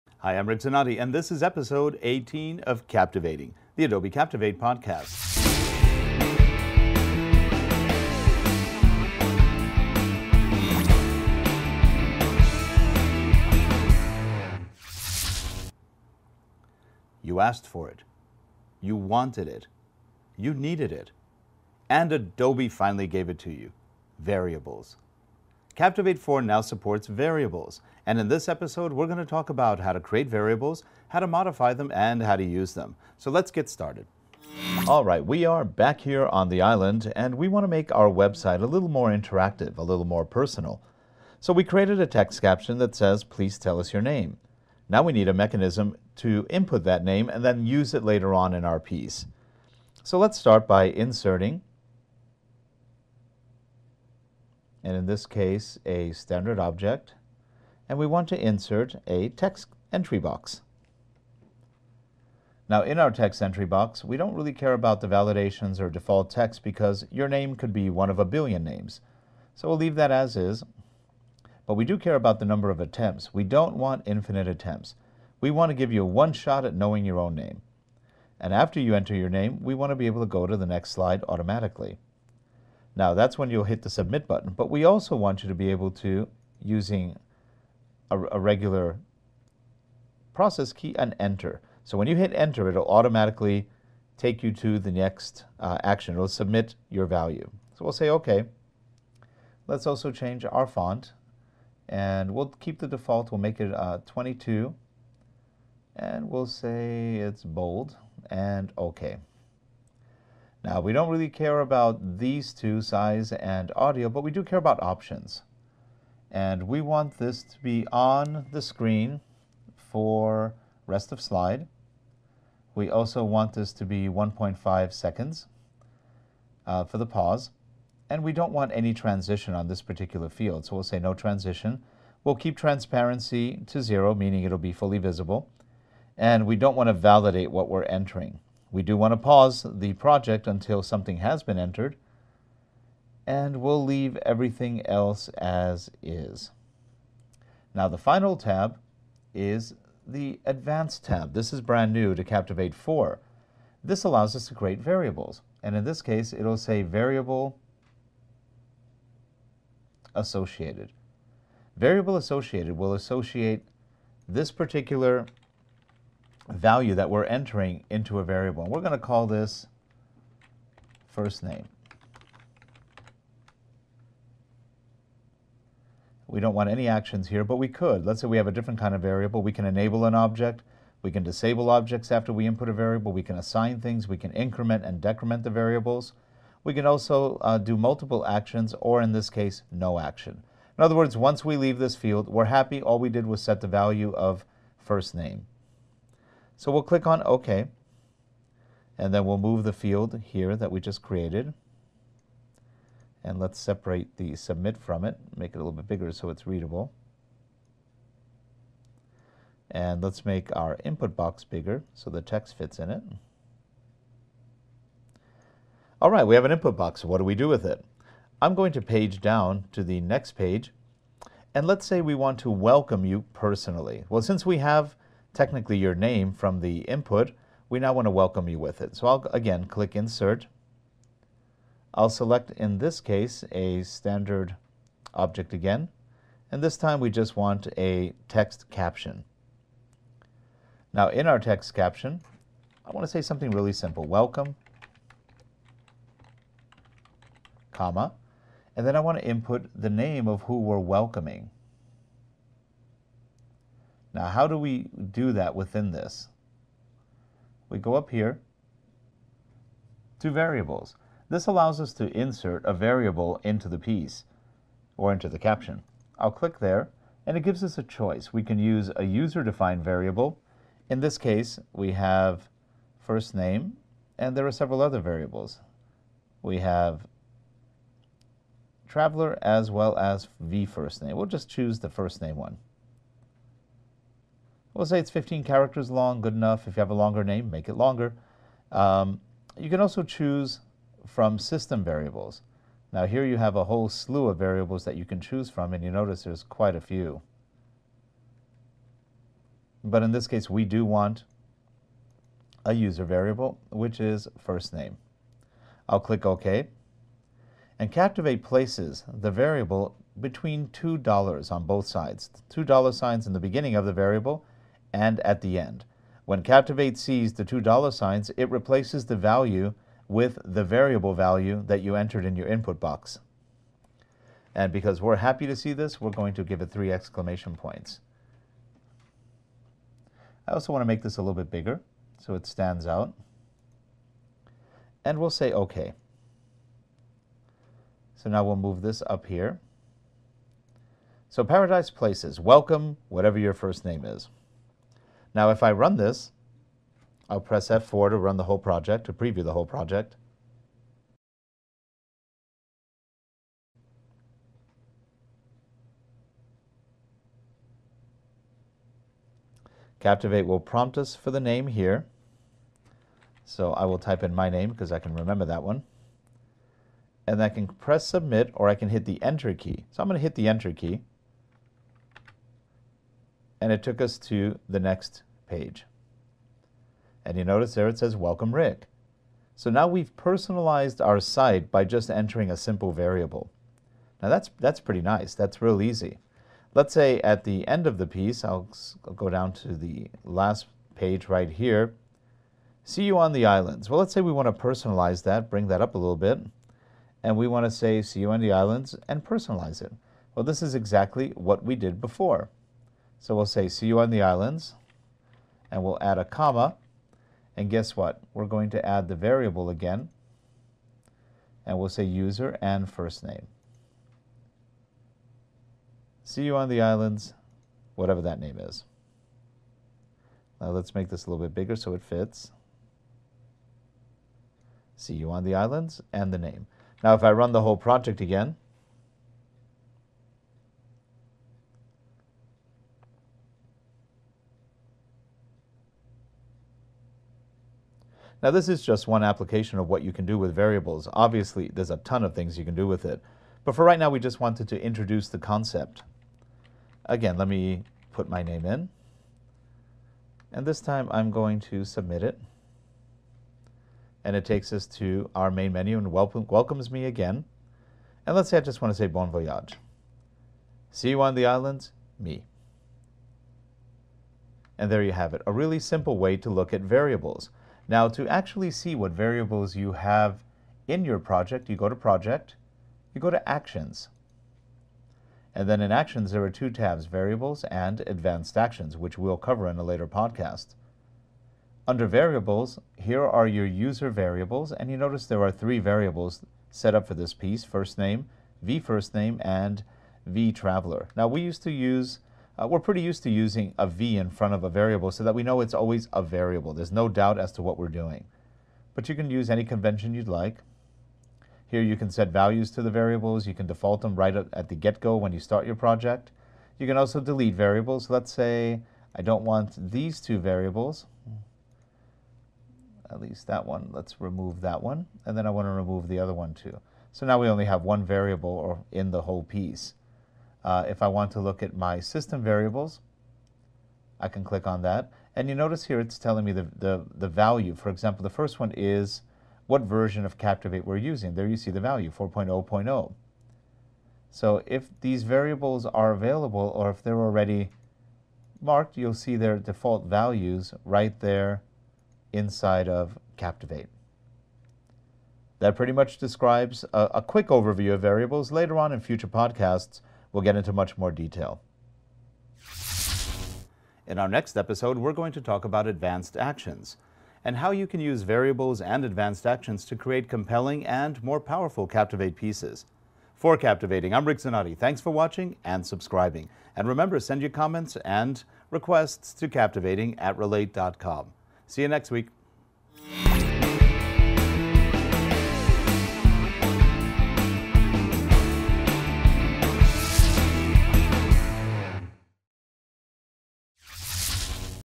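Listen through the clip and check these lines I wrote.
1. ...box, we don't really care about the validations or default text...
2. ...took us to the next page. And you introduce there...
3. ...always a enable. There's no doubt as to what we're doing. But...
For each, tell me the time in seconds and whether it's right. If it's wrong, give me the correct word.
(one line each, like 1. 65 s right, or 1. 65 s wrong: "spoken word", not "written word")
1. 63 s right
2. 373 s wrong: "notice", not "introduce"
3. 495 s wrong: "variable", not "enable".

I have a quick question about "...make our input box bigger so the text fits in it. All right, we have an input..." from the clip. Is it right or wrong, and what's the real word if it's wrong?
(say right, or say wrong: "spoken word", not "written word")
right.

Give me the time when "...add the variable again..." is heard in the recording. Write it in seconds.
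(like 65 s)
408 s.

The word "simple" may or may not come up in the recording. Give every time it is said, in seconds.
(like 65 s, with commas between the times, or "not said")
243 s, 382 s, 465 s.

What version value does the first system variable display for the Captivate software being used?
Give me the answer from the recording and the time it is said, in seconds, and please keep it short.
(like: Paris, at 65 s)
4.0.0, at 532 s.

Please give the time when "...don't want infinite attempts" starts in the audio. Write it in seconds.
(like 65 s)
73 s.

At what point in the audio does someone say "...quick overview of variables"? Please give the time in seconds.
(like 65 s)
547 s.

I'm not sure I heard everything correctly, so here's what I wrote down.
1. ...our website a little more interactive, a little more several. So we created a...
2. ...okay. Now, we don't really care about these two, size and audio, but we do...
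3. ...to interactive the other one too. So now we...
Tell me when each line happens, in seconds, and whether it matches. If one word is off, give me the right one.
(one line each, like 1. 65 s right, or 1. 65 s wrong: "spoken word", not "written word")
1. 37 s wrong: "personal", not "several"
2. 108 s right
3. 515 s wrong: "remove", not "interactive".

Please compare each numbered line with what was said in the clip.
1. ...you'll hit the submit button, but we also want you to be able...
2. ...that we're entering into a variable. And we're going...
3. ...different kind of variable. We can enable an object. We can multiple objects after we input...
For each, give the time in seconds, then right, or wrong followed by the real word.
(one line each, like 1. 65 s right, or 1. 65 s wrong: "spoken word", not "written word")
1. 83 s right
2. 166 s right
3. 178 s wrong: "disable", not "multiple".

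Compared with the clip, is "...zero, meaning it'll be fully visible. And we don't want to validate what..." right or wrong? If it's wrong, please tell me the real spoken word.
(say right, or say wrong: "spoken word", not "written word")
right.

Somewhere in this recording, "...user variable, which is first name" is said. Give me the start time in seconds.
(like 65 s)
302 s.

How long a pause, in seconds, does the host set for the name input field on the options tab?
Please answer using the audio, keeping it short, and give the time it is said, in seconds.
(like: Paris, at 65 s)
1.5 seconds, at 124 s.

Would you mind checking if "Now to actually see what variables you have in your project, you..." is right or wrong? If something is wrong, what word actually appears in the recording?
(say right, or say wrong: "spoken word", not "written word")
right.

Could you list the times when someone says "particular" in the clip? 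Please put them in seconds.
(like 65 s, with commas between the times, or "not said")
129 s, 164 s.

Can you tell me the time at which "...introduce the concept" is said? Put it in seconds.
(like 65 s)
444 s.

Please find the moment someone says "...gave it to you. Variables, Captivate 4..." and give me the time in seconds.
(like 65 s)
23 s.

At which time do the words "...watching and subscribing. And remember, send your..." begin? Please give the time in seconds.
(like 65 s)
565 s.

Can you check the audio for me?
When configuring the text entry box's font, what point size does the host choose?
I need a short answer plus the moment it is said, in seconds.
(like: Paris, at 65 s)
22, at 104 s.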